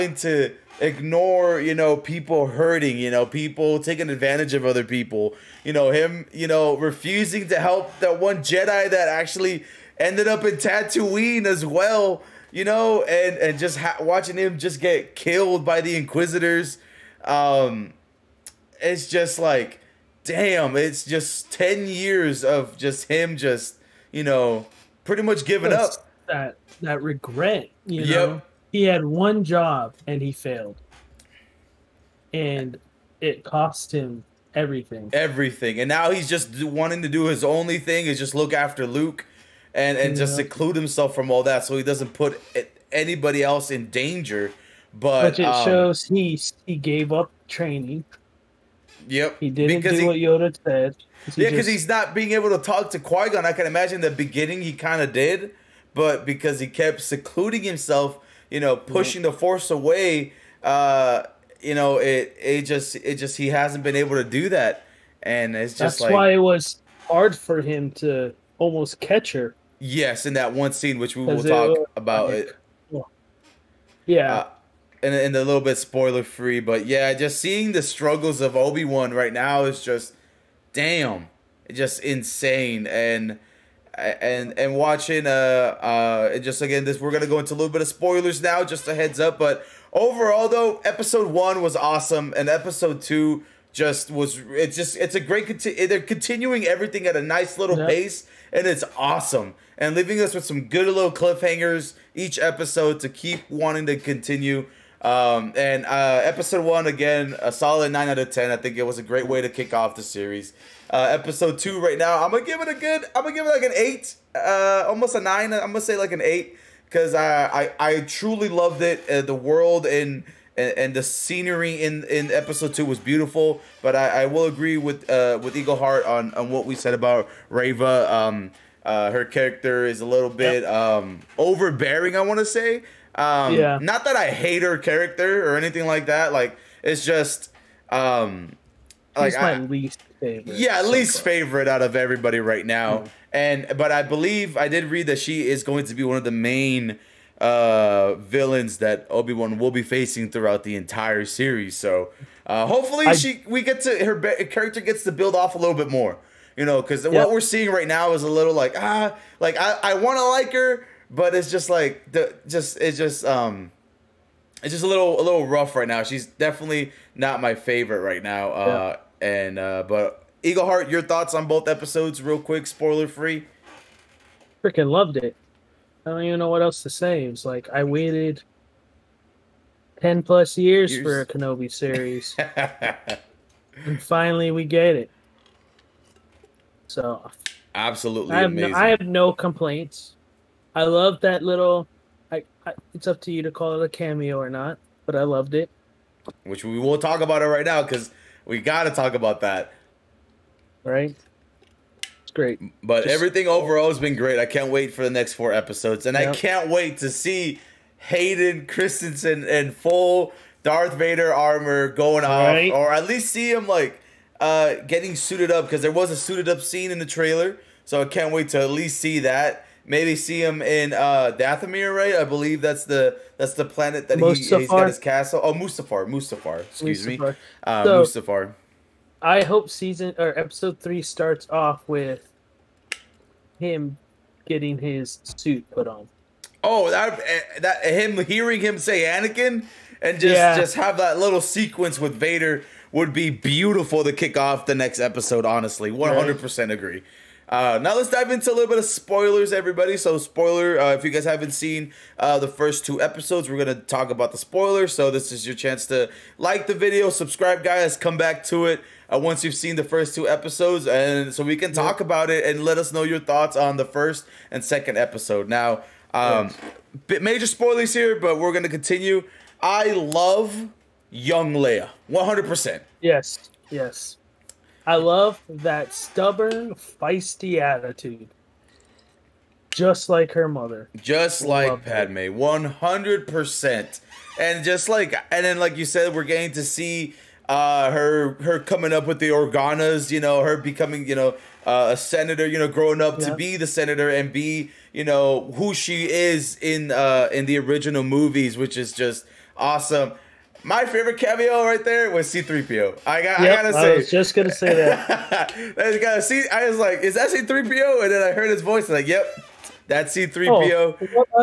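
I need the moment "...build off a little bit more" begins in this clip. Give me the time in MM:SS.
02:35.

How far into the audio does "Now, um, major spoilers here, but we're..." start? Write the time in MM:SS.
04:25.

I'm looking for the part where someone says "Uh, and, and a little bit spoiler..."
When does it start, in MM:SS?
01:14.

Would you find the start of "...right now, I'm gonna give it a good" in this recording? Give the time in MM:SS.
01:51.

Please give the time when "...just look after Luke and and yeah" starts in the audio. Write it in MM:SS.
00:38.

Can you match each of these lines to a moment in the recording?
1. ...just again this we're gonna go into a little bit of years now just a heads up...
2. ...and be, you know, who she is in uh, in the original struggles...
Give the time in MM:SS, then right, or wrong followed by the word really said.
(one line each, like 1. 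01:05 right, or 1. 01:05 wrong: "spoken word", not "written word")
1. 01:26 wrong: "spoilers", not "years"
2. 04:54 wrong: "movies", not "struggles".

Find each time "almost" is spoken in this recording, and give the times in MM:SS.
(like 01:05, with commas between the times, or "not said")
01:08, 01:54.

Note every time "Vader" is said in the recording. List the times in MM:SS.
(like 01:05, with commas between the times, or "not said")
03:30, 04:02.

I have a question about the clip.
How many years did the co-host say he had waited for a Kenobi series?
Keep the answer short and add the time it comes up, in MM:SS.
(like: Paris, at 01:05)
10 plus, at 02:59.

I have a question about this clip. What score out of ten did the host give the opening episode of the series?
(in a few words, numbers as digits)
9.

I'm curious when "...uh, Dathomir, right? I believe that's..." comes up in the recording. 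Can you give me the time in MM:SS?
03:40.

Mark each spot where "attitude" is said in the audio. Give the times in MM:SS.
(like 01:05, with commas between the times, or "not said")
04:37.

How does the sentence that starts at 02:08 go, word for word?
Um, uh, her character is a little bit yep.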